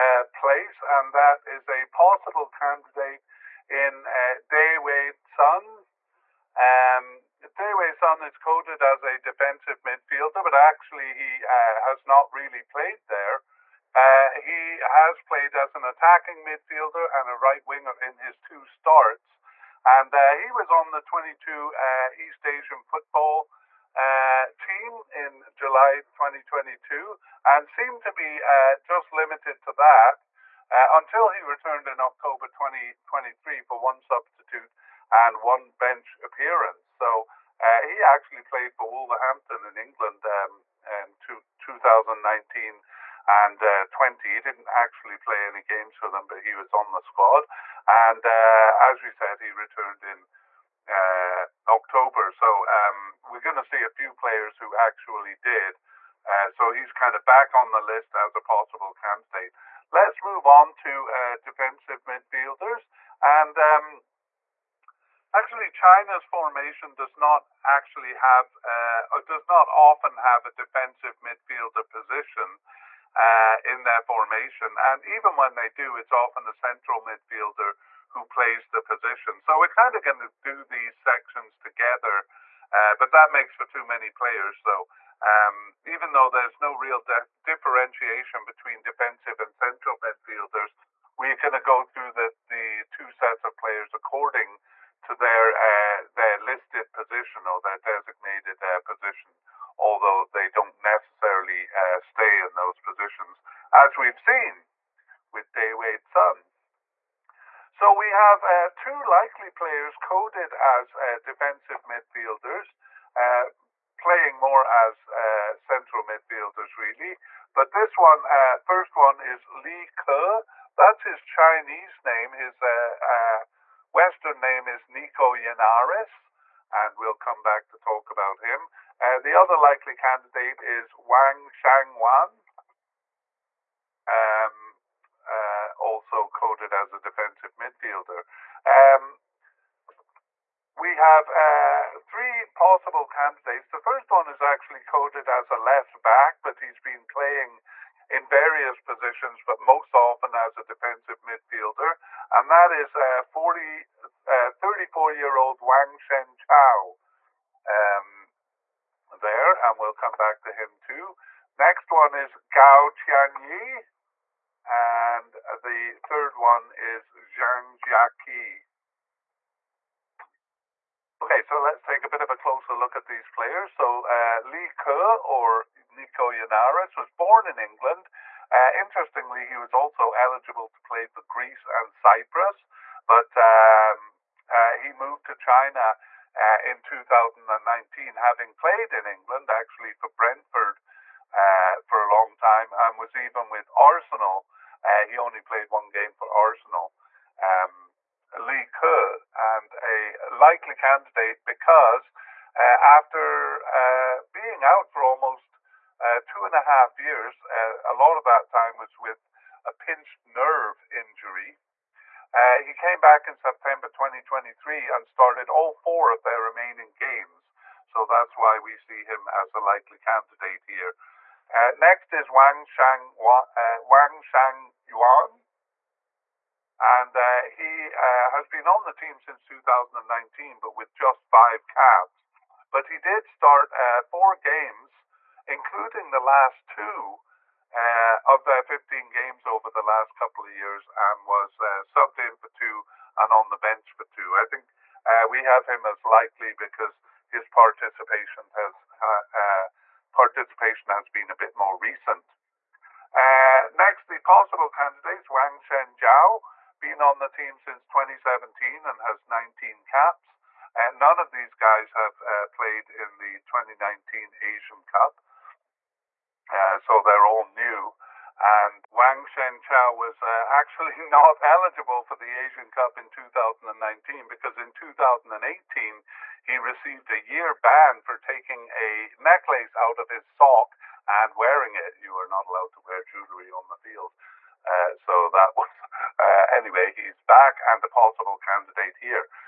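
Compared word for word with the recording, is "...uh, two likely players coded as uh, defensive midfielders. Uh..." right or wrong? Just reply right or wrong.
right.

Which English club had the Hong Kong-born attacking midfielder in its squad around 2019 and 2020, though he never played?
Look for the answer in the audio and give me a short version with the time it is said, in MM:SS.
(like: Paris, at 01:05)
Wolverhampton, at 00:38.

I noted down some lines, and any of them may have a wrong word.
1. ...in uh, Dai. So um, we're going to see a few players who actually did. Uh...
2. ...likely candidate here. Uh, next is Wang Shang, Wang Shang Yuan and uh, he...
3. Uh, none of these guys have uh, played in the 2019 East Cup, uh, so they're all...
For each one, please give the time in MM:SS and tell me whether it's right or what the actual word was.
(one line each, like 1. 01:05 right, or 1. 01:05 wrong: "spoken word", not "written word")
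1. 00:50 wrong: "October", not "Dai"
2. 03:39 right
3. 04:20 wrong: "Asian", not "East".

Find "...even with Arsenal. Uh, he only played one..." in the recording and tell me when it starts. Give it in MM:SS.
03:13.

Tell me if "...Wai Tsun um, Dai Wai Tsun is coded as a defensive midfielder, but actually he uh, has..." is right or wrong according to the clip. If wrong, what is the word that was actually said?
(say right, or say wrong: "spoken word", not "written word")
right.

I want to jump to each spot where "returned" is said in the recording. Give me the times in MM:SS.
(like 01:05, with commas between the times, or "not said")
00:31, 00:49.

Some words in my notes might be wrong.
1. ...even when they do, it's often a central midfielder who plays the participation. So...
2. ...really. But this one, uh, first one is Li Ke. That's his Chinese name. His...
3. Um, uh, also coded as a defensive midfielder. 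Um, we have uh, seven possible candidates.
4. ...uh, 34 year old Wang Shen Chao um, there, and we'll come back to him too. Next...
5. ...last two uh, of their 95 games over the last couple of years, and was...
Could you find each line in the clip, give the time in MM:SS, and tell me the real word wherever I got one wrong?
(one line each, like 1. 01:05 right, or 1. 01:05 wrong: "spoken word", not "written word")
1. 01:15 wrong: "position", not "participation"
2. 01:56 right
3. 02:14 wrong: "three", not "seven"
4. 02:34 right
5. 03:56 wrong: "15", not "95".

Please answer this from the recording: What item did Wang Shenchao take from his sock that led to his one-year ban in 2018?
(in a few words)
A necklace.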